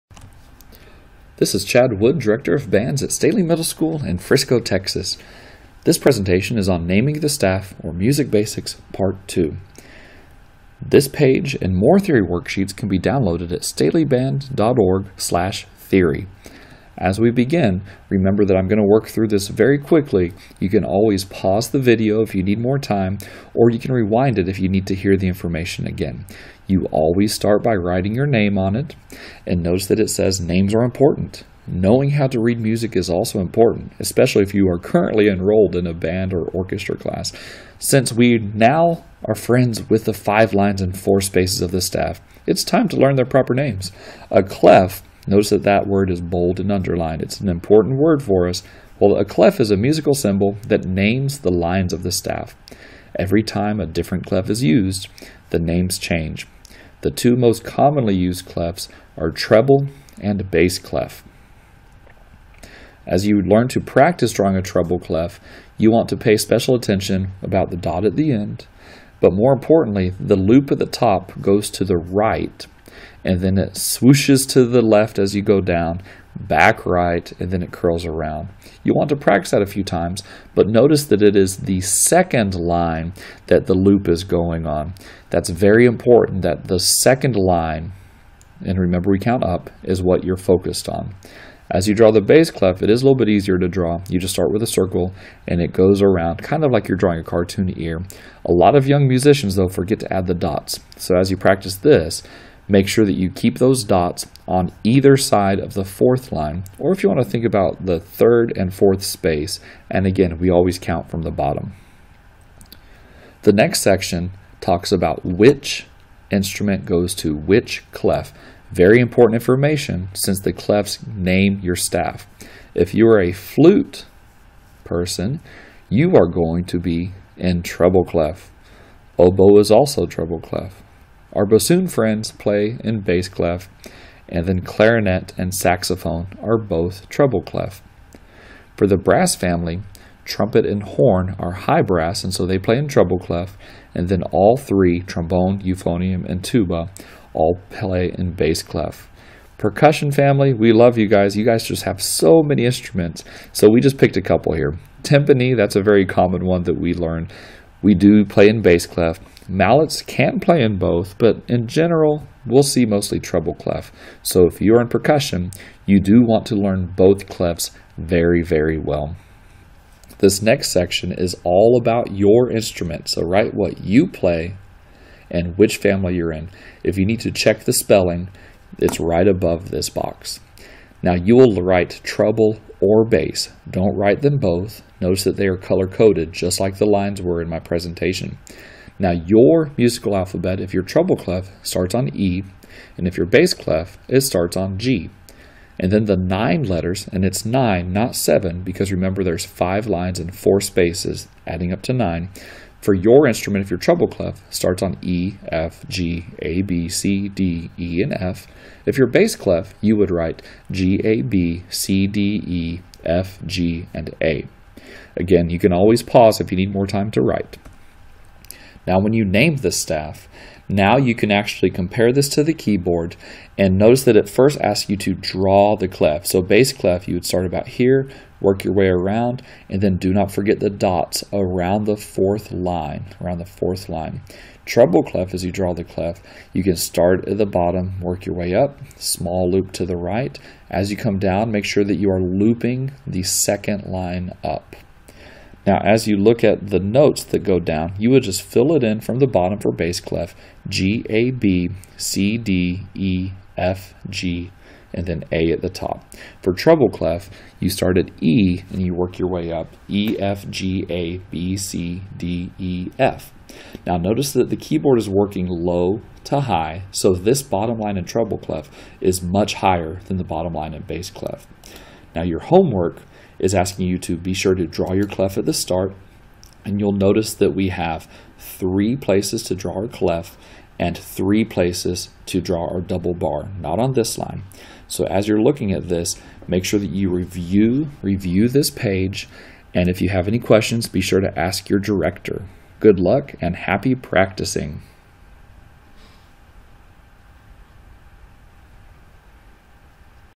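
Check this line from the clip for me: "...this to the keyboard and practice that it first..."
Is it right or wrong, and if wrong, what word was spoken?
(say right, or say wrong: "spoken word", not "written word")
wrong: "notice", not "practice".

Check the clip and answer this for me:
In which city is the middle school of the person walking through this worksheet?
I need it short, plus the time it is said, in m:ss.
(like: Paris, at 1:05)
Frisco, at 0:04.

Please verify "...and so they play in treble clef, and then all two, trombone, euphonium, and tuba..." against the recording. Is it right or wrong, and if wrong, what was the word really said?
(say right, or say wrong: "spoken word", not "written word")
wrong: "three", not "two".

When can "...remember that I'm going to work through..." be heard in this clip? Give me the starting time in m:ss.
0:18.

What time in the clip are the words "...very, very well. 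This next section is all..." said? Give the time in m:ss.
2:47.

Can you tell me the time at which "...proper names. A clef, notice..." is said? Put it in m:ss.
0:43.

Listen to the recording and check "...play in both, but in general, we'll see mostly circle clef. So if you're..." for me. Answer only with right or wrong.
wrong.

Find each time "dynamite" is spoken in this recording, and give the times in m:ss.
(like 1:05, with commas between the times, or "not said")
not said.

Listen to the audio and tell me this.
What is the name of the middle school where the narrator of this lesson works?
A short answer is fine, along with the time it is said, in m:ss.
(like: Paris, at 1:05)
Staley Middle School, at 0:03.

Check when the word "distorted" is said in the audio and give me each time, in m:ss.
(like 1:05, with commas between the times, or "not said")
not said.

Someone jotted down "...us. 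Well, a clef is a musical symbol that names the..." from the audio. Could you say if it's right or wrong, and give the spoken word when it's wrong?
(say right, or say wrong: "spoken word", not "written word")
right.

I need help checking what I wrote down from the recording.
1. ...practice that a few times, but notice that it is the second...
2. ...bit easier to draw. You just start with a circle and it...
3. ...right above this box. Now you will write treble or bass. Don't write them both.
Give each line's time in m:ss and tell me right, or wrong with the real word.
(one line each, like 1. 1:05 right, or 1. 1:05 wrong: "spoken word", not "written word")
1. 1:19 right
2. 1:33 right
3. 2:59 right.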